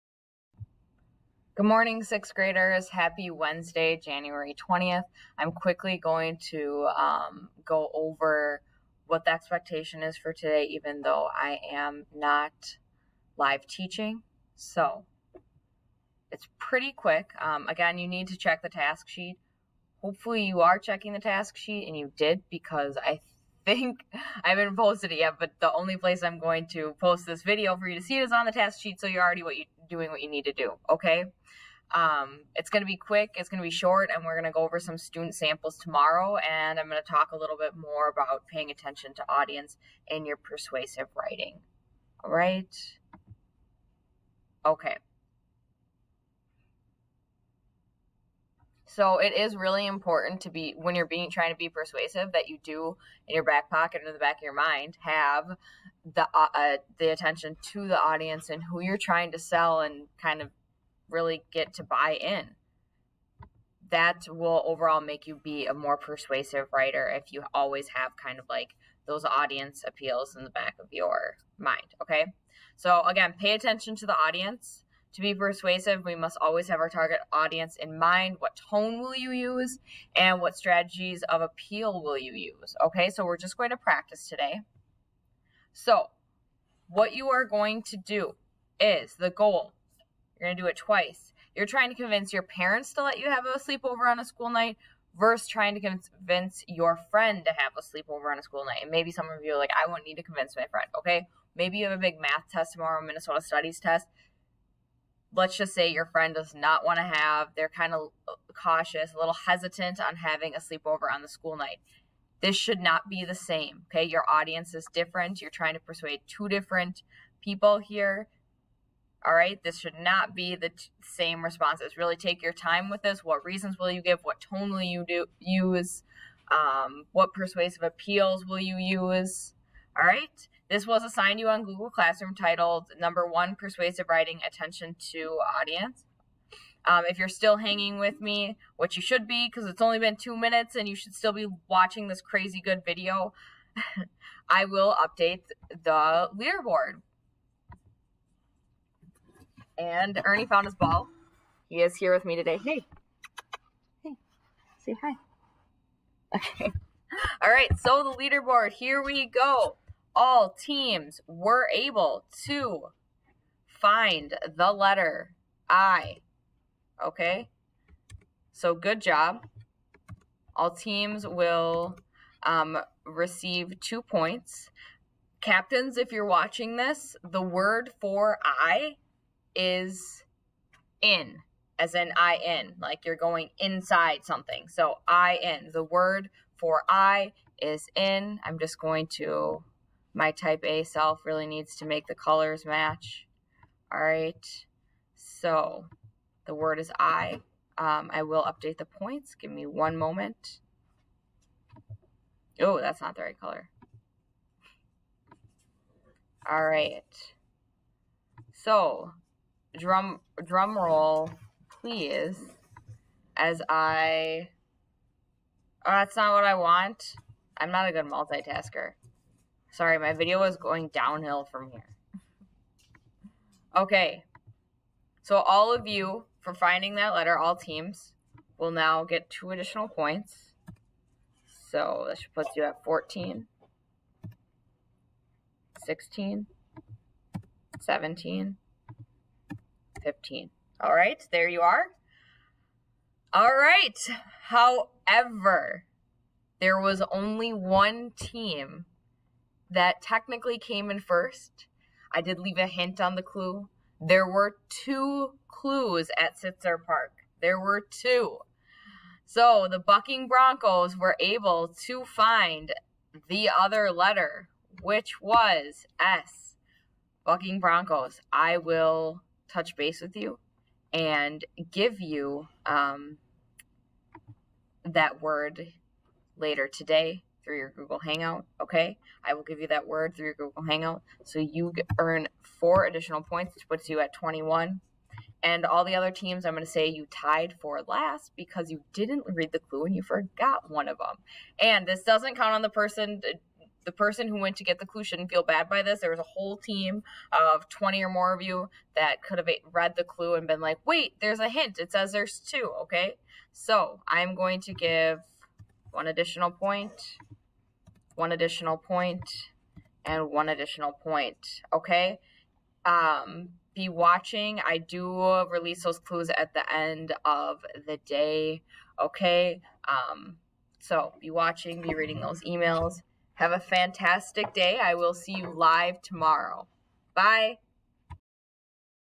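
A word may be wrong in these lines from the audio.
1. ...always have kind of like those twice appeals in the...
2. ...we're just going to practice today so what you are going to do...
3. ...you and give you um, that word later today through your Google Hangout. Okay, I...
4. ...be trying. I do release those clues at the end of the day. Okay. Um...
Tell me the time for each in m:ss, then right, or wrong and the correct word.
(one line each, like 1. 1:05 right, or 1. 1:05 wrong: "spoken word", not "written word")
1. 1:07 wrong: "audience", not "twice"
2. 1:23 right
3. 4:30 right
4. 5:13 wrong: "watching", not "trying".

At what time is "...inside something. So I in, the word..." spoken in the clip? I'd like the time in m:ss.
3:03.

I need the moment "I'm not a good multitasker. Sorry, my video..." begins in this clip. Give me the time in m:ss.
3:37.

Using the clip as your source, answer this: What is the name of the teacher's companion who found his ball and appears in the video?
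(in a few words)
Ernie.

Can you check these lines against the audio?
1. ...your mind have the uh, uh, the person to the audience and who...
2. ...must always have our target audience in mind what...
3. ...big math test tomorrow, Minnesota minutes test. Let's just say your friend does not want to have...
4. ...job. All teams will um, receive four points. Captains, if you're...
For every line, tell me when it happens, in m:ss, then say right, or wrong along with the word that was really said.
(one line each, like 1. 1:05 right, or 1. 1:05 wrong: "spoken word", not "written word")
1. 0:54 wrong: "attention", not "person"
2. 1:16 right
3. 1:42 wrong: "studies", not "minutes"
4. 2:49 wrong: "two", not "four".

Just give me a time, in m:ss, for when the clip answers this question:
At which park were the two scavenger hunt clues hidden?
4:16.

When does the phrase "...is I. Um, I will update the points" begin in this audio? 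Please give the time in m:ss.
3:16.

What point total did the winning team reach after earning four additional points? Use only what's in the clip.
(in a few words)
21.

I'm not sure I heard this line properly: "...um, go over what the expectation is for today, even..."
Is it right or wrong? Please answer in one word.
right.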